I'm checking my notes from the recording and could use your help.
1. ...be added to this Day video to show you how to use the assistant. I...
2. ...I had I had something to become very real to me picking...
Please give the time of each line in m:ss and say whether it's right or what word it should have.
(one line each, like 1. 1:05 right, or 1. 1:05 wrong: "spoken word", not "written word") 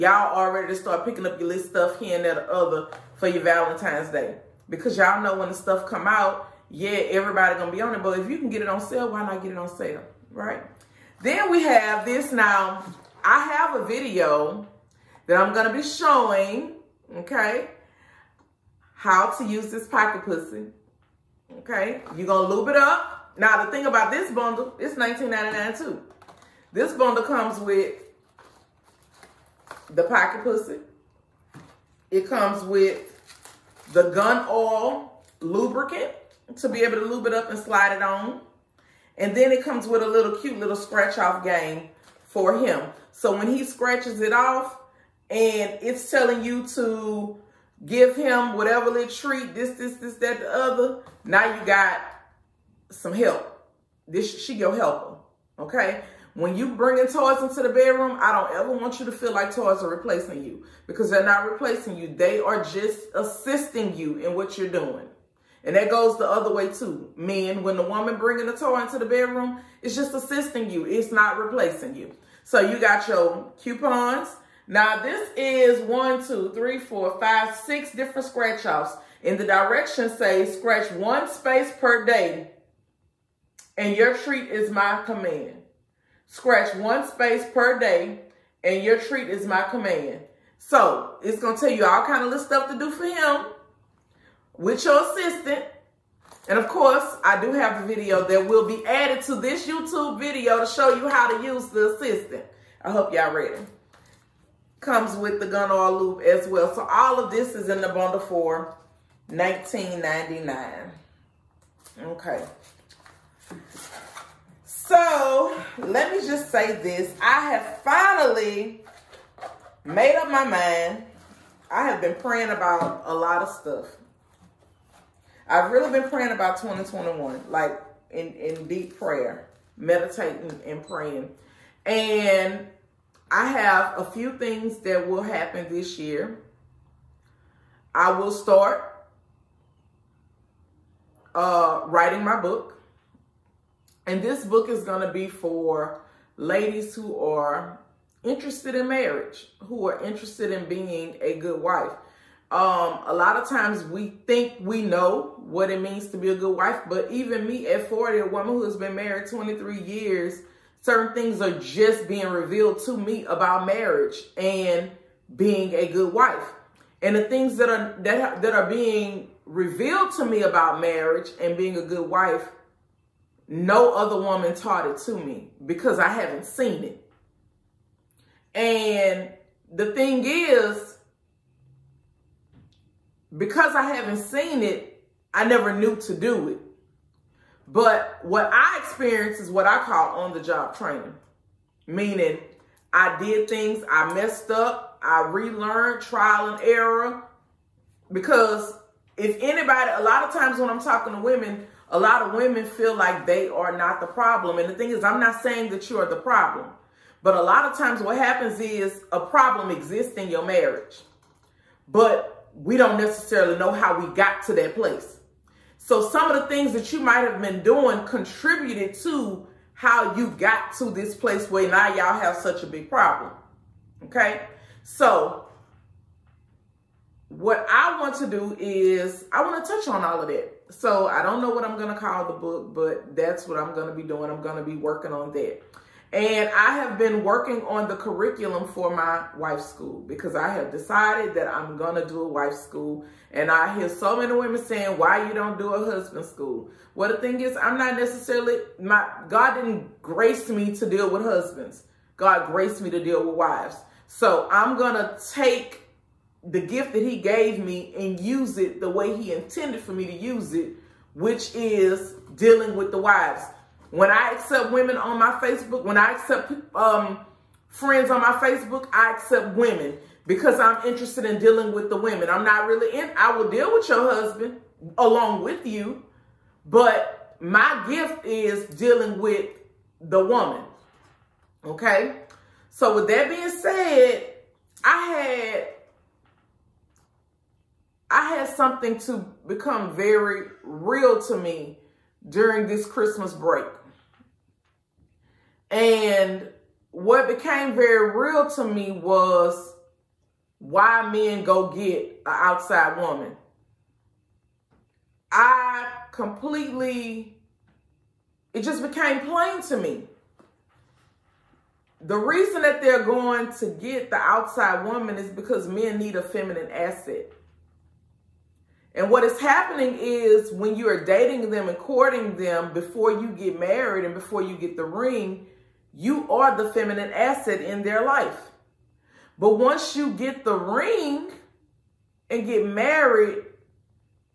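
1. 1:38 wrong: "YouTube", not "Day"
2. 4:44 wrong: "during", not "picking".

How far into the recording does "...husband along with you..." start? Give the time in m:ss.
4:34.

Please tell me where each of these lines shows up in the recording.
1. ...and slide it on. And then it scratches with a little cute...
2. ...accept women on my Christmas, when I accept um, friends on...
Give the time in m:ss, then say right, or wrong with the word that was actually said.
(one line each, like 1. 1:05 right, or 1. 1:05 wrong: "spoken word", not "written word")
1. 0:37 wrong: "comes", not "scratches"
2. 4:24 wrong: "Facebook", not "Christmas".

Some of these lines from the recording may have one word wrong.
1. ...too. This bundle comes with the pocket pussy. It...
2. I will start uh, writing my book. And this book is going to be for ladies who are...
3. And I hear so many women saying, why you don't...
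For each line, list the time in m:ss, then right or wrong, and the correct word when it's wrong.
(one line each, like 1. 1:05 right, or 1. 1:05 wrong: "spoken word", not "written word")
1. 0:25 right
2. 2:17 right
3. 4:03 right.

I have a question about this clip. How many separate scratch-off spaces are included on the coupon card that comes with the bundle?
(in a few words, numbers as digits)
6.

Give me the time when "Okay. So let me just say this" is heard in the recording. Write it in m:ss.
1:52.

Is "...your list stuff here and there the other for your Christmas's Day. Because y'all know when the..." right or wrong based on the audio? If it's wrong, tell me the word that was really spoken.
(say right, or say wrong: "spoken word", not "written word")
wrong: "Valentine", not "Christmas".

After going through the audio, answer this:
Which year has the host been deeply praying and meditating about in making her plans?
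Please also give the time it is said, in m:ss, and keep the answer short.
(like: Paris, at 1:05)
2021, at 2:06.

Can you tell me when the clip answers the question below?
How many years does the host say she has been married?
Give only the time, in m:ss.
2:39.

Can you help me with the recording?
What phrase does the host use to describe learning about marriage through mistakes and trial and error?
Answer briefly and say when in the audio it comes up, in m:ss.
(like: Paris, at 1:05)
on the job training, at 3:10.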